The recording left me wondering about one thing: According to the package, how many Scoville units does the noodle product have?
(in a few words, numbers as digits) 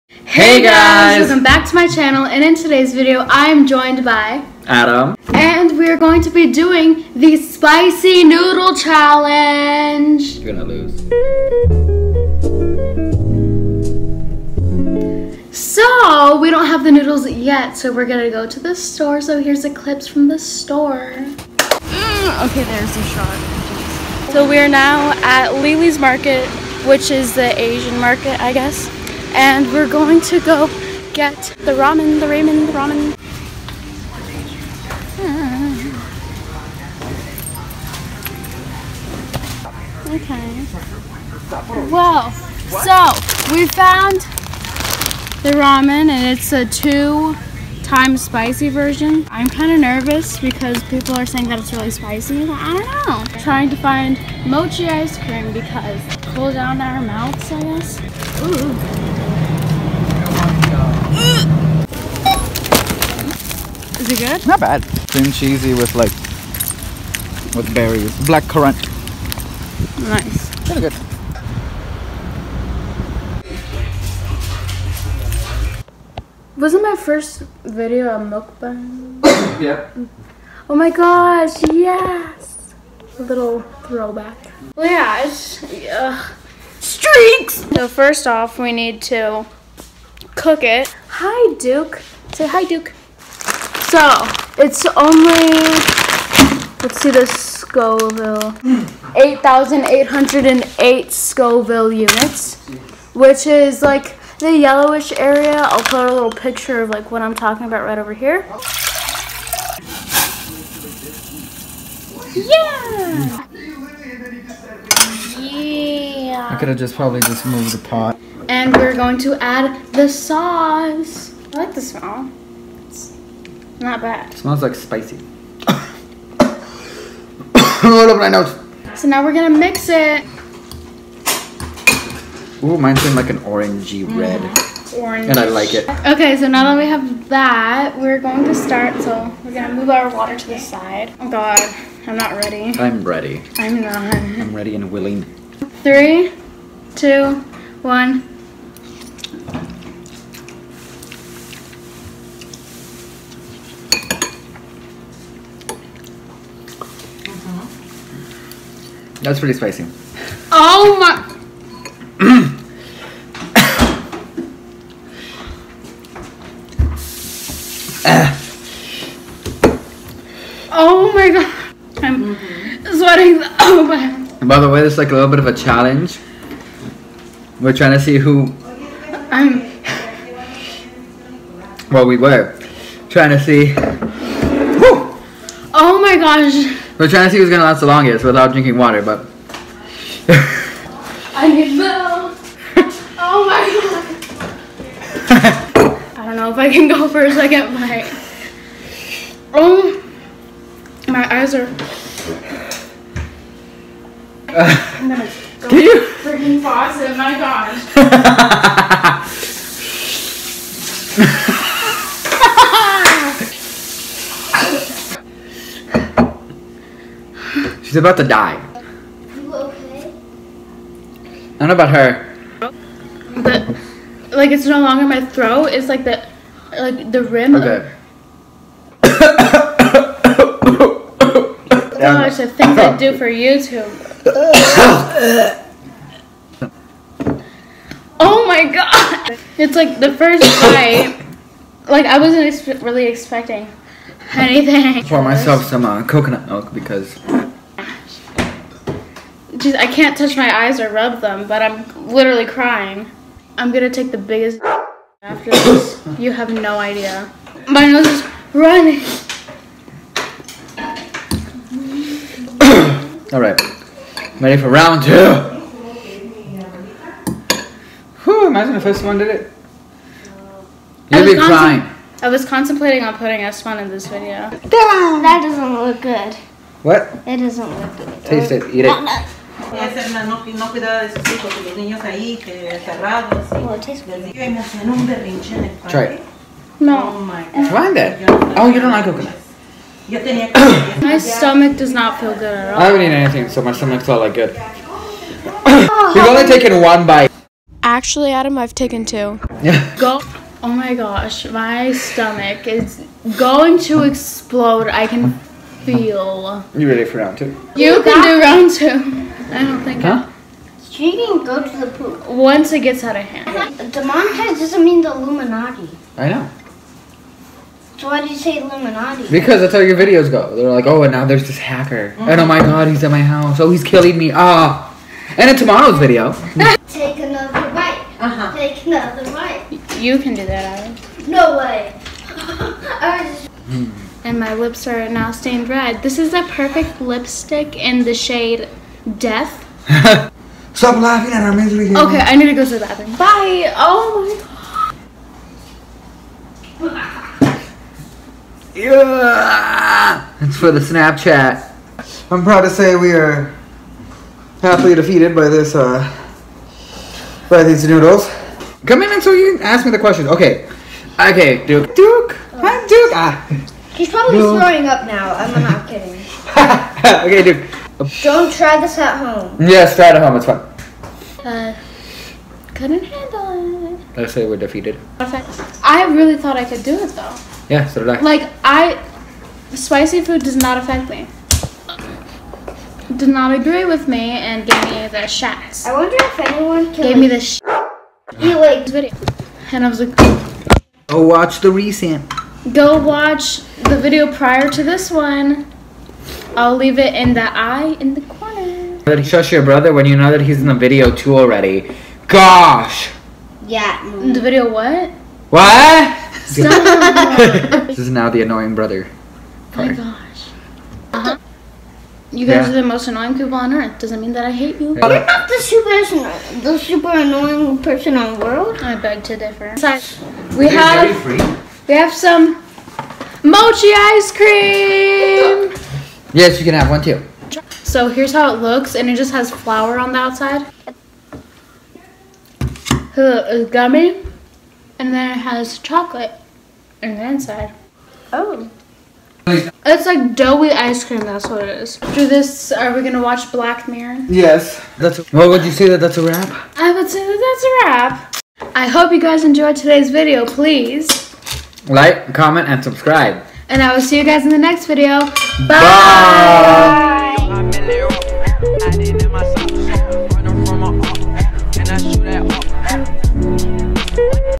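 8,808.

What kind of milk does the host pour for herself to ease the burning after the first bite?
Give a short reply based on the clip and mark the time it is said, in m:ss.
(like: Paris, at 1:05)
coconut milk, at 4:06.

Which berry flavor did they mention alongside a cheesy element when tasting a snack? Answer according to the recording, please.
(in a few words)
black currant.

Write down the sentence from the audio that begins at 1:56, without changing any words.
I could have just probably just moved the pot.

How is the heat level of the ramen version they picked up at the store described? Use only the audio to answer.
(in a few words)
two time spicy.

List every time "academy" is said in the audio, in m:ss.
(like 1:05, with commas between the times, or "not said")
not said.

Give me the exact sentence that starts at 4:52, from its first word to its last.
I haven't eaten anything, so my stomach felt like good.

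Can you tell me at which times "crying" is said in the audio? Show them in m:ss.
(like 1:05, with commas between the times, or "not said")
4:12, 4:31.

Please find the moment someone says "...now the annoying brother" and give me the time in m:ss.
6:48.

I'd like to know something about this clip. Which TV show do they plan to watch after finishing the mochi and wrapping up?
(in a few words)
Black Mirror.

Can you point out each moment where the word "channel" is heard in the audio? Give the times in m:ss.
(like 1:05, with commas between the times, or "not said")
0:01.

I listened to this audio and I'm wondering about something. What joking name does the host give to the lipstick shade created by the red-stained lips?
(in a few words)
Death.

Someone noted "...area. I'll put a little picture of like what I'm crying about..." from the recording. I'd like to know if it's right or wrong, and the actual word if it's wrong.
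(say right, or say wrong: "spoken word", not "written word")
wrong: "talking", not "crying".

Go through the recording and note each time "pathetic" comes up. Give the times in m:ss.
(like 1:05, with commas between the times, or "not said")
not said.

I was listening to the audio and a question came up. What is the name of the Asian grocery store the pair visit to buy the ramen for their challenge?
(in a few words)
Lily's Market.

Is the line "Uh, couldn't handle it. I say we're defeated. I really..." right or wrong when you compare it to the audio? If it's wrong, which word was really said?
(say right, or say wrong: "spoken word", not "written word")
right.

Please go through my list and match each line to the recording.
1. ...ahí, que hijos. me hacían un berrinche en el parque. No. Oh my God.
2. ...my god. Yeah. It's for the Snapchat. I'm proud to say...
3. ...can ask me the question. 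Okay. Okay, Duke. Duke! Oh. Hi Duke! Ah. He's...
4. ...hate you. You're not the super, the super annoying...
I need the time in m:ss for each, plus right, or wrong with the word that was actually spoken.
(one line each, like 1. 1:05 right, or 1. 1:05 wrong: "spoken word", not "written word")
1. 4:42 wrong: "encerrados", not "hijos"
2. 5:46 right
3. 5:59 right
4. 6:54 right.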